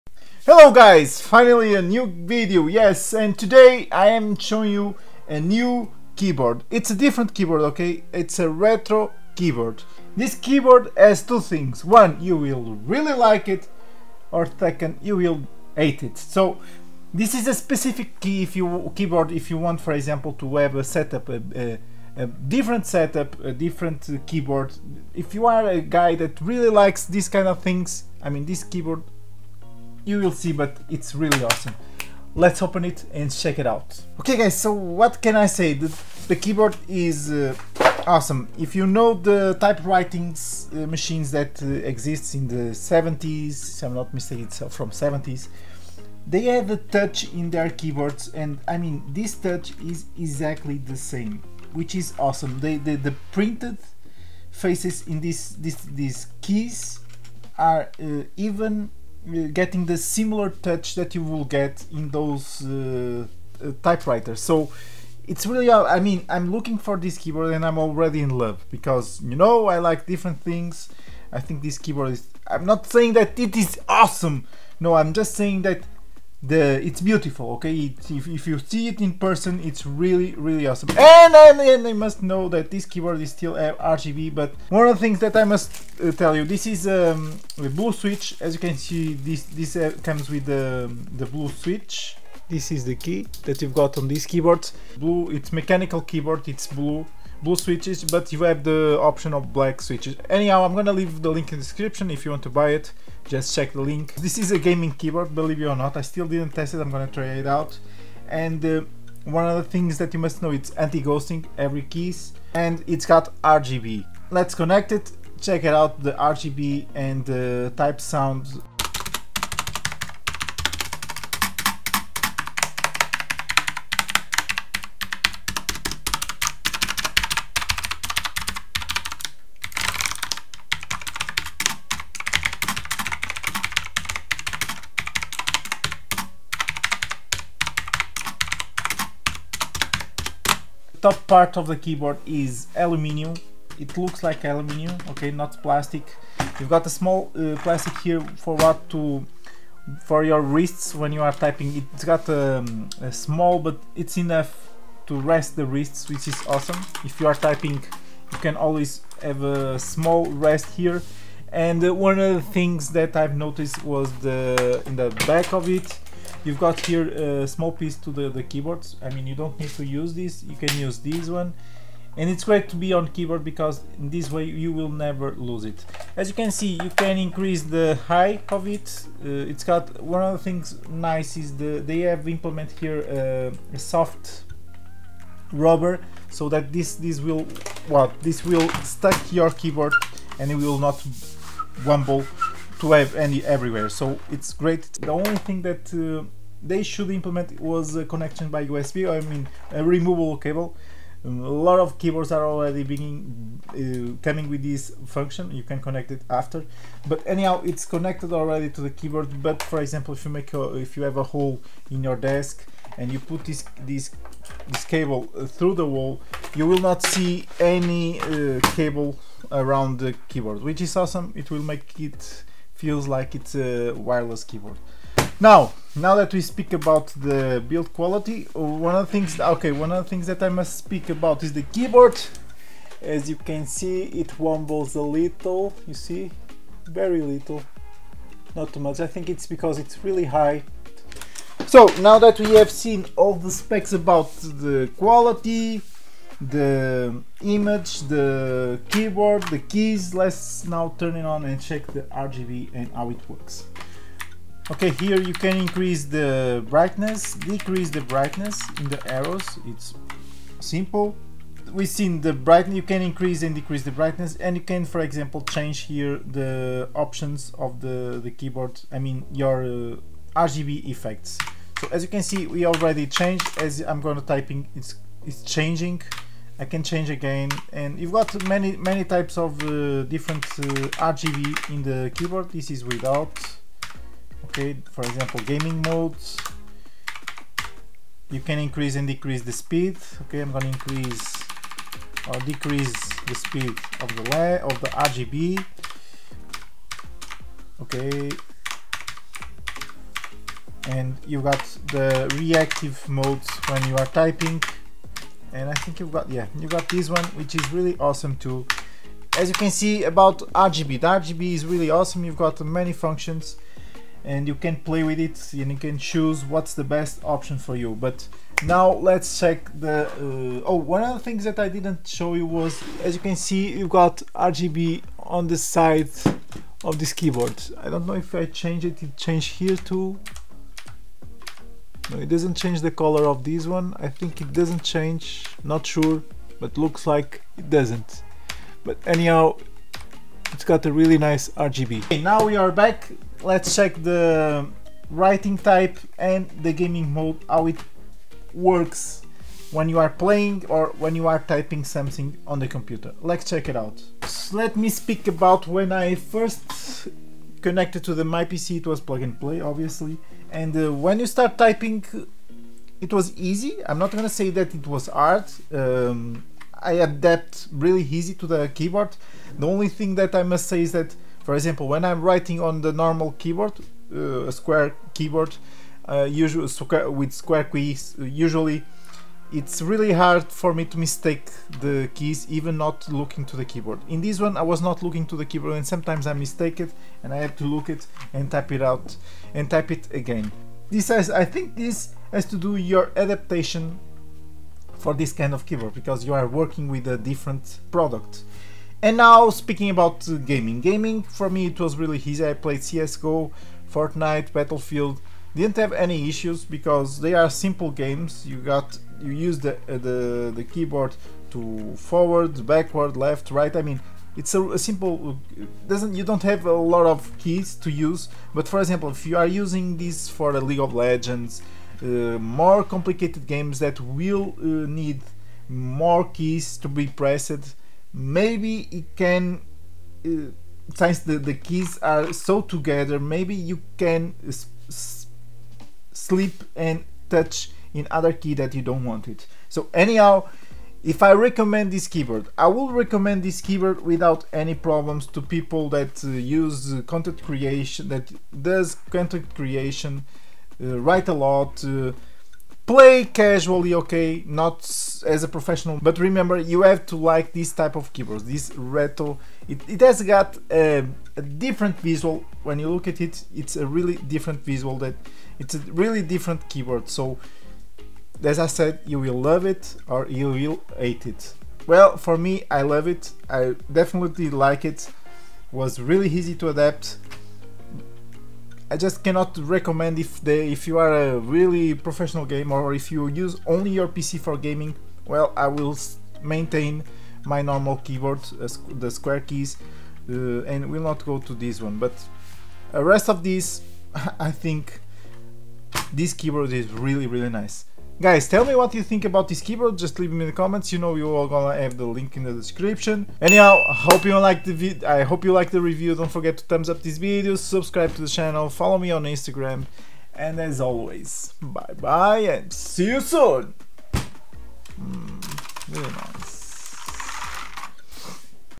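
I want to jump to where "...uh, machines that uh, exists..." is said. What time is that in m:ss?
0:40.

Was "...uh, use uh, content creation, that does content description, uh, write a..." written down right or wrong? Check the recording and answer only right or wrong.
wrong.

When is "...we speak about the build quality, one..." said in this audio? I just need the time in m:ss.
3:46.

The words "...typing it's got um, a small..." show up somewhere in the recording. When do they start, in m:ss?
2:31.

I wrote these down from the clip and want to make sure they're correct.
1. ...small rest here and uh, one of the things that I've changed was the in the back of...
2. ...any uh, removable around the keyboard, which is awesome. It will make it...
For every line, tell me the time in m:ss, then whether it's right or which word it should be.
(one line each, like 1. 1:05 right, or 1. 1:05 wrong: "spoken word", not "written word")
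1. 2:39 wrong: "noticed", not "changed"
2. 3:37 wrong: "cable", not "removable".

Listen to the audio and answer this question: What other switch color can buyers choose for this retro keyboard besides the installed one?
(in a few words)
Black.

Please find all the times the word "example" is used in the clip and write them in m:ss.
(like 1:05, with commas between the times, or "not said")
0:19, 3:29, 4:25, 4:45, 6:11, 6:58.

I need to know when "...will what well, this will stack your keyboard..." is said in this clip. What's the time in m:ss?
3:07.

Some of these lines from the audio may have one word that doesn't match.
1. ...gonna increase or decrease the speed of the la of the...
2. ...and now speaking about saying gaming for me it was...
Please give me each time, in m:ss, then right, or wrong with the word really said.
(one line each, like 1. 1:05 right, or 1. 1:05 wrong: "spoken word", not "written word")
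1. 4:50 right
2. 6:39 wrong: "gaming", not "saying".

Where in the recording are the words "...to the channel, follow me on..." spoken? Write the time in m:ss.
8:28.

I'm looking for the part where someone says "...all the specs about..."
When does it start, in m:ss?
4:03.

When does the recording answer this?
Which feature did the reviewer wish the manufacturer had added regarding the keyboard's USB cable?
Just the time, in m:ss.
3:19.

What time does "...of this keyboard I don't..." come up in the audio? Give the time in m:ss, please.
5:26.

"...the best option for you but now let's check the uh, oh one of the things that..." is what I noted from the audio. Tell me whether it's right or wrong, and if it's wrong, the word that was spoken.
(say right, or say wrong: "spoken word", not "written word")
right.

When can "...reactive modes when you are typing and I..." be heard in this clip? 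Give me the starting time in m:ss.
5:02.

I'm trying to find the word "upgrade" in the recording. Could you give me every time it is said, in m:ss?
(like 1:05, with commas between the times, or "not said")
not said.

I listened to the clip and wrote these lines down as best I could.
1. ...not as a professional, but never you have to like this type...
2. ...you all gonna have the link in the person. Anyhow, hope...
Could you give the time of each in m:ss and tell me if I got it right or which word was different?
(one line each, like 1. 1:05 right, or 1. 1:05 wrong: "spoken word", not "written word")
1. 7:34 wrong: "remember", not "never"
2. 8:21 wrong: "description", not "person".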